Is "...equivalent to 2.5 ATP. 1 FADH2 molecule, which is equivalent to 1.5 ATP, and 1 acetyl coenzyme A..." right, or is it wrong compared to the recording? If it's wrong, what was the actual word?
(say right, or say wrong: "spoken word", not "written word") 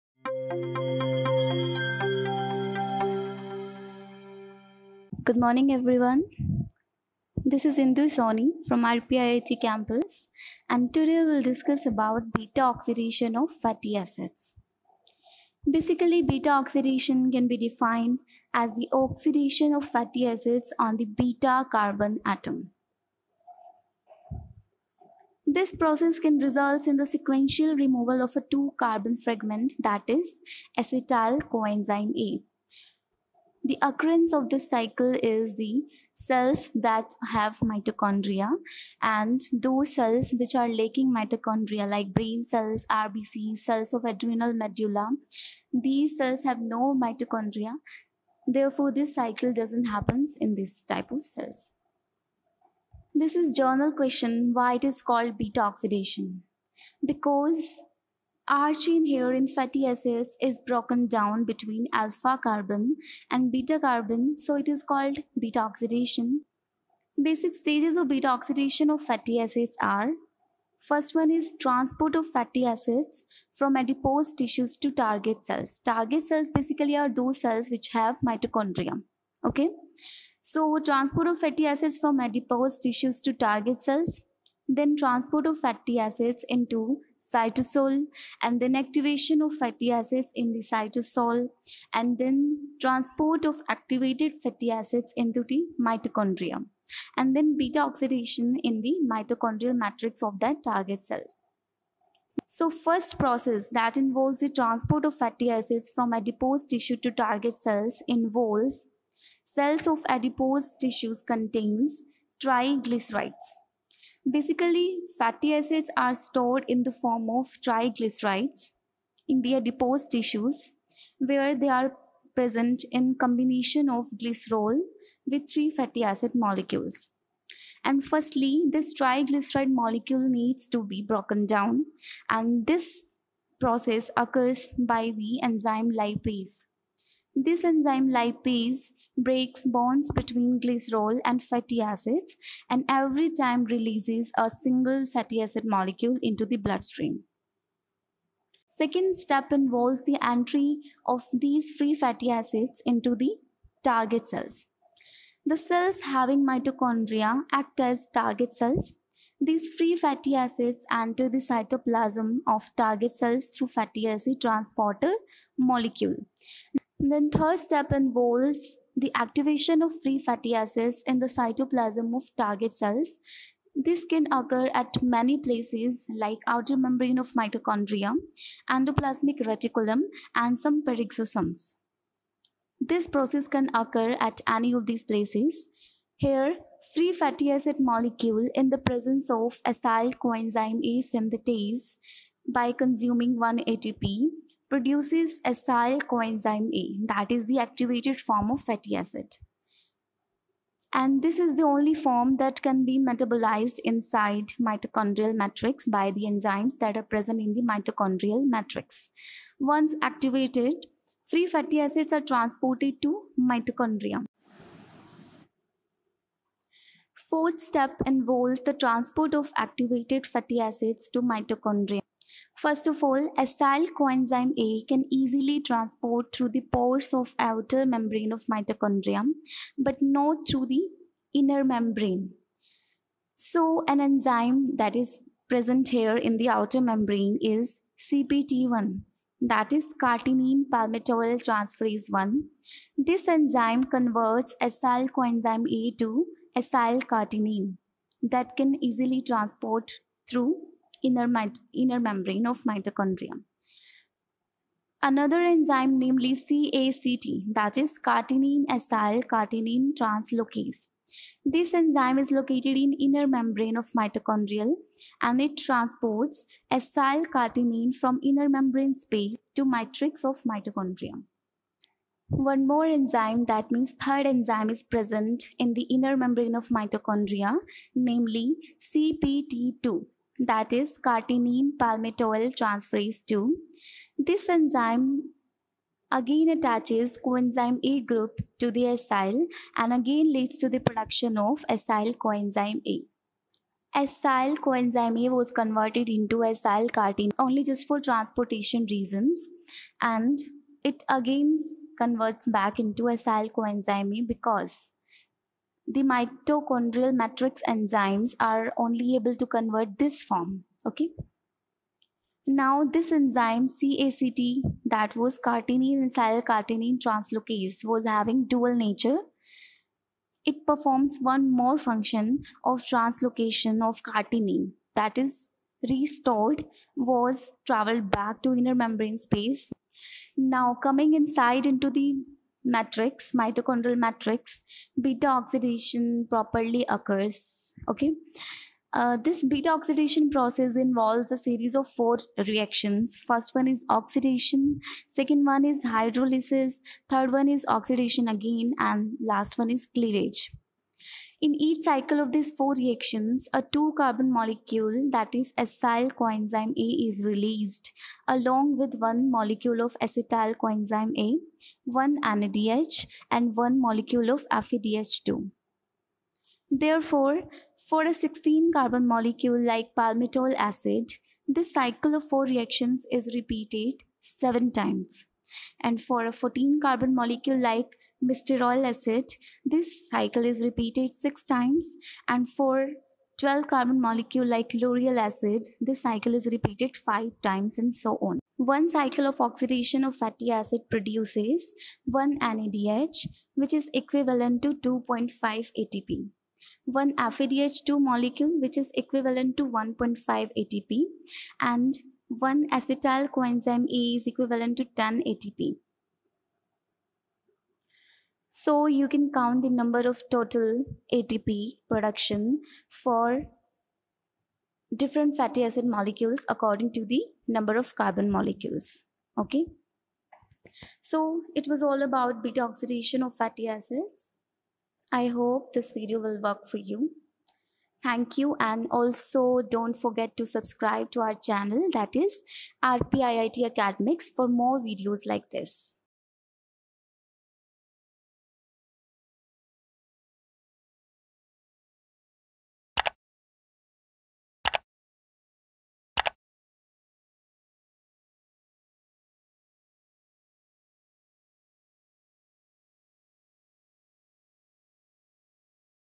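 right.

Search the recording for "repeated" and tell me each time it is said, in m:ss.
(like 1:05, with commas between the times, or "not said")
6:13, 6:20, 6:26.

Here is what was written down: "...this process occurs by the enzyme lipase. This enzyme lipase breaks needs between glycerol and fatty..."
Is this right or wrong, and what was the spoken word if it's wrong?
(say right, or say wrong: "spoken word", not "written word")
wrong: "bonds", not "needs".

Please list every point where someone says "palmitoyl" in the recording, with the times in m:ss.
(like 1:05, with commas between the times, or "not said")
4:00, 4:41, 6:09.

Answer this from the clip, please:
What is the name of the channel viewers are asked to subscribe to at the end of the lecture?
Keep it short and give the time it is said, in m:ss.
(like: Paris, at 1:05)
RPIIT Academics, at 7:12.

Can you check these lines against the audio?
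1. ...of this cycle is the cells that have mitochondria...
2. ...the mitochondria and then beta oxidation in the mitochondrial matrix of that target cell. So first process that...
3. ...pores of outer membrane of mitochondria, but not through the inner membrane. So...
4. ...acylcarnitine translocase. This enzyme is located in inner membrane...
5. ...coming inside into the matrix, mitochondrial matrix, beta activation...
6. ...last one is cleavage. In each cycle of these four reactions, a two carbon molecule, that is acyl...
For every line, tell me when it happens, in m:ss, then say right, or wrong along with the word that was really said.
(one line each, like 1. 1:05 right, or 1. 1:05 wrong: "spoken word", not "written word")
1. 0:34 right
2. 1:35 right
3. 3:46 right
4. 4:18 right
5. 5:30 wrong: "oxidation", not "activation"
6. 5:49 right.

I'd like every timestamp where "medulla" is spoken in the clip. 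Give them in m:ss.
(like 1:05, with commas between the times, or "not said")
0:44.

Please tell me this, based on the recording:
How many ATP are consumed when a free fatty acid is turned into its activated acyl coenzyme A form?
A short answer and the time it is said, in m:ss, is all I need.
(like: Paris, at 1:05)
1, at 3:13.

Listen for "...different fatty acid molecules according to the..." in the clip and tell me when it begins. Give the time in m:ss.
6:54.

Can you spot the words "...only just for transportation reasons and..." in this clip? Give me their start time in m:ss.
4:57.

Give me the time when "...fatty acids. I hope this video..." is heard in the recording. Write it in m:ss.
7:03.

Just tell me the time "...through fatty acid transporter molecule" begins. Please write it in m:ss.
2:43.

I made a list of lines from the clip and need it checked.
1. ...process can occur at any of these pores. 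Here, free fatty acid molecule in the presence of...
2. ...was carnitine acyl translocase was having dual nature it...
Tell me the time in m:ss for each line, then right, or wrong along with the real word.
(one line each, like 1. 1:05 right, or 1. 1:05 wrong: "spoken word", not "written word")
1. 3:03 wrong: "places", not "pores"
2. 5:15 right.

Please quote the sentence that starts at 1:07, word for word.
Basic stages of beta oxidation of fatty acids are First one is transport of fatty acids from adipose tissues to target cells.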